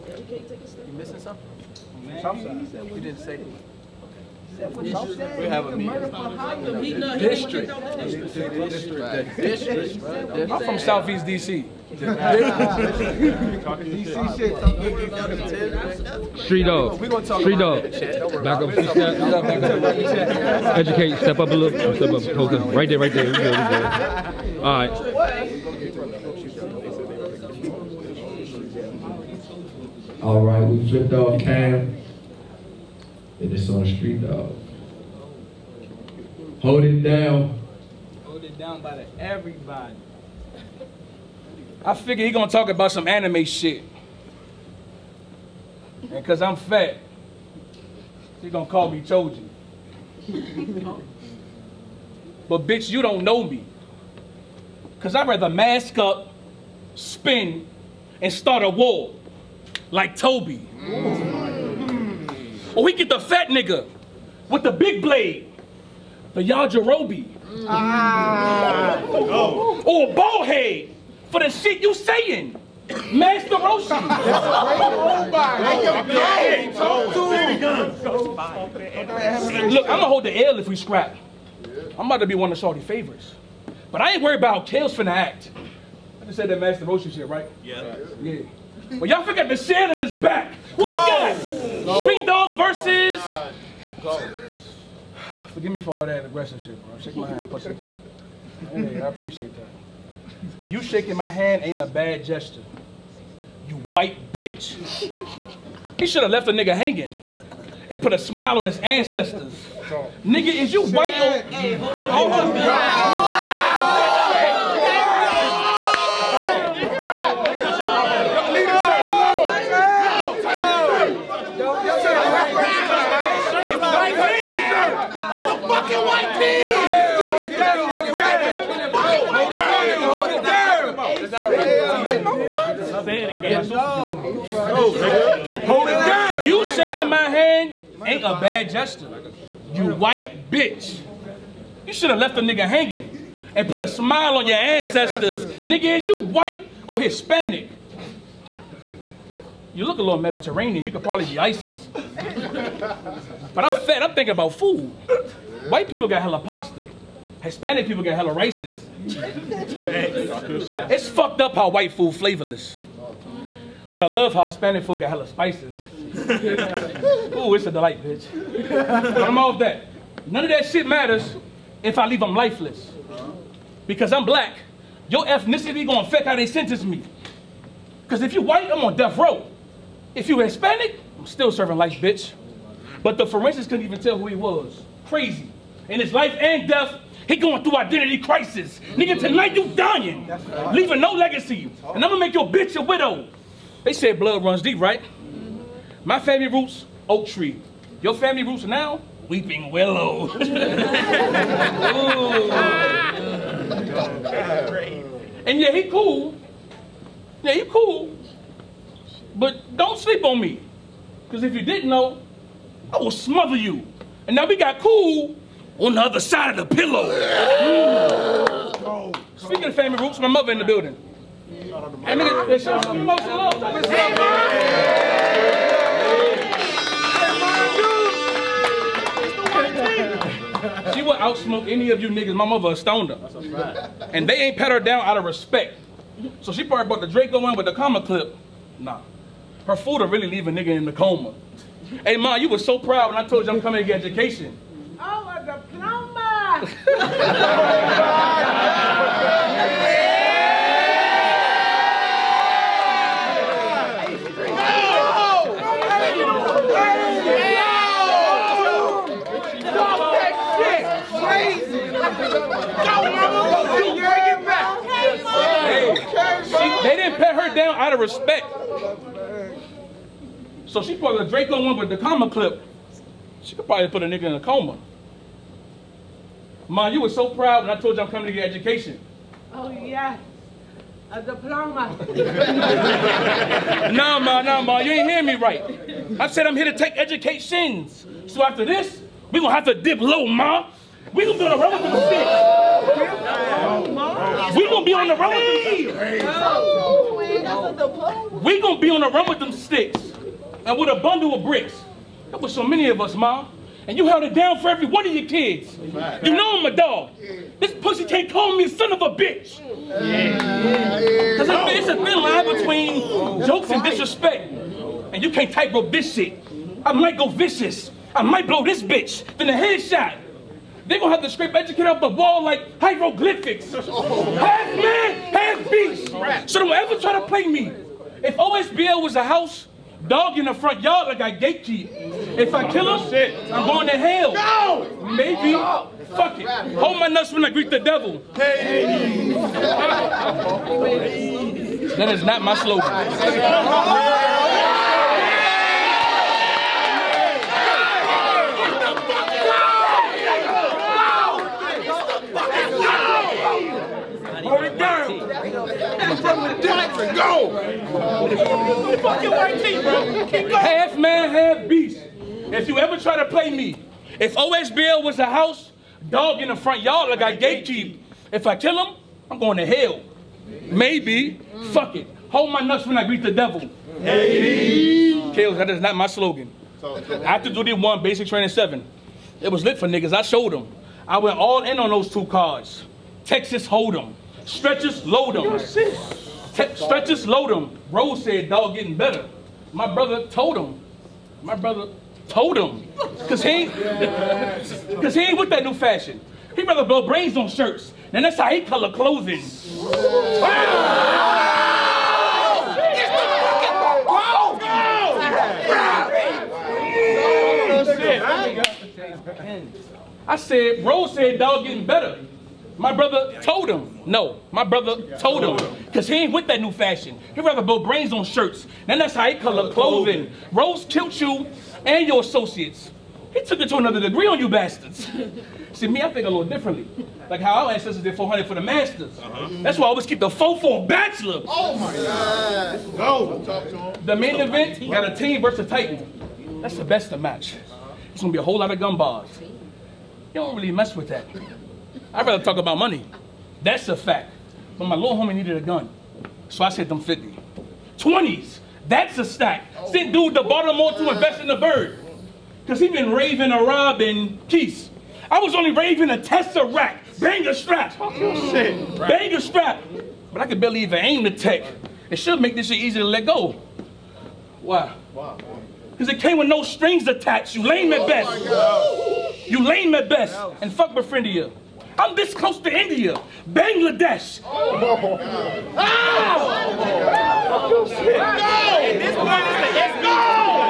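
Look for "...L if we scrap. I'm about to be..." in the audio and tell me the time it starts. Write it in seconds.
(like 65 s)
80 s.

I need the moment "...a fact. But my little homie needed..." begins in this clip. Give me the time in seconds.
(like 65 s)
443 s.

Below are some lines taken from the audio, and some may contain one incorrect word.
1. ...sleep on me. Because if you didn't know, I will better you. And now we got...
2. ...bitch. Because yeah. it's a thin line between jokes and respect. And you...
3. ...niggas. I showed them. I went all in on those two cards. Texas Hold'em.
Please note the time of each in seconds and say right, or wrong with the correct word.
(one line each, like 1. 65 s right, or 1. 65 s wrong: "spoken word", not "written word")
1. 209 s wrong: "smother", not "better"
2. 309 s wrong: "disrespect", not "respect"
3. 379 s right.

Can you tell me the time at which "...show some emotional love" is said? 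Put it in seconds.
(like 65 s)
222 s.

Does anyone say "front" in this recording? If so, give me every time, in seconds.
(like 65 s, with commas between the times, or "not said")
330 s, 366 s.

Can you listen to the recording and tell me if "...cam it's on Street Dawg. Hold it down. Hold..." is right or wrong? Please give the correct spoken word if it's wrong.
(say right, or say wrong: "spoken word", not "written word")
right.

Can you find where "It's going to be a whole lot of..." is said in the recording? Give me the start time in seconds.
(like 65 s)
438 s.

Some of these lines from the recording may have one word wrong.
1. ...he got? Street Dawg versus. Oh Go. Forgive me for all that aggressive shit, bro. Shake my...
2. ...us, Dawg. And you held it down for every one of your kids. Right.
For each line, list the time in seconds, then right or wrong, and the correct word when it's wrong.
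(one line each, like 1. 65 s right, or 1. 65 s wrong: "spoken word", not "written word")
1. 90 s right
2. 303 s wrong: "Mom", not "Dawg".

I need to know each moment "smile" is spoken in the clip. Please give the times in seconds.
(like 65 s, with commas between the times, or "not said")
108 s, 143 s.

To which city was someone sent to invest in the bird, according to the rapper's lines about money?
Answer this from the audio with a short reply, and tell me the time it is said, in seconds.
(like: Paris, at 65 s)
Baltimore, at 450 s.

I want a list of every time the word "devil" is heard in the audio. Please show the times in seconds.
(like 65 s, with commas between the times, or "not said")
337 s, 373 s.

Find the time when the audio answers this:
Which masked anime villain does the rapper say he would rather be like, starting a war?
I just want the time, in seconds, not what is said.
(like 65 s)
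60 s.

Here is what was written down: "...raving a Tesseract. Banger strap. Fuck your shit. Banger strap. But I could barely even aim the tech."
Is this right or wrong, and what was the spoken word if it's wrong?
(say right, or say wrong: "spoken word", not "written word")
right.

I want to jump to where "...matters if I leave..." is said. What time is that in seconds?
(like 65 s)
170 s.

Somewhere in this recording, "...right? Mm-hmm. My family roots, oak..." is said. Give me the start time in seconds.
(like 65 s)
194 s.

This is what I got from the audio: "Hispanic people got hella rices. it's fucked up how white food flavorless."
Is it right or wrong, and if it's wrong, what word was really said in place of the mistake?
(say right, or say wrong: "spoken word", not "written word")
right.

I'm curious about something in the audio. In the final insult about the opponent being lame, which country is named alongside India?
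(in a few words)
Bangladesh.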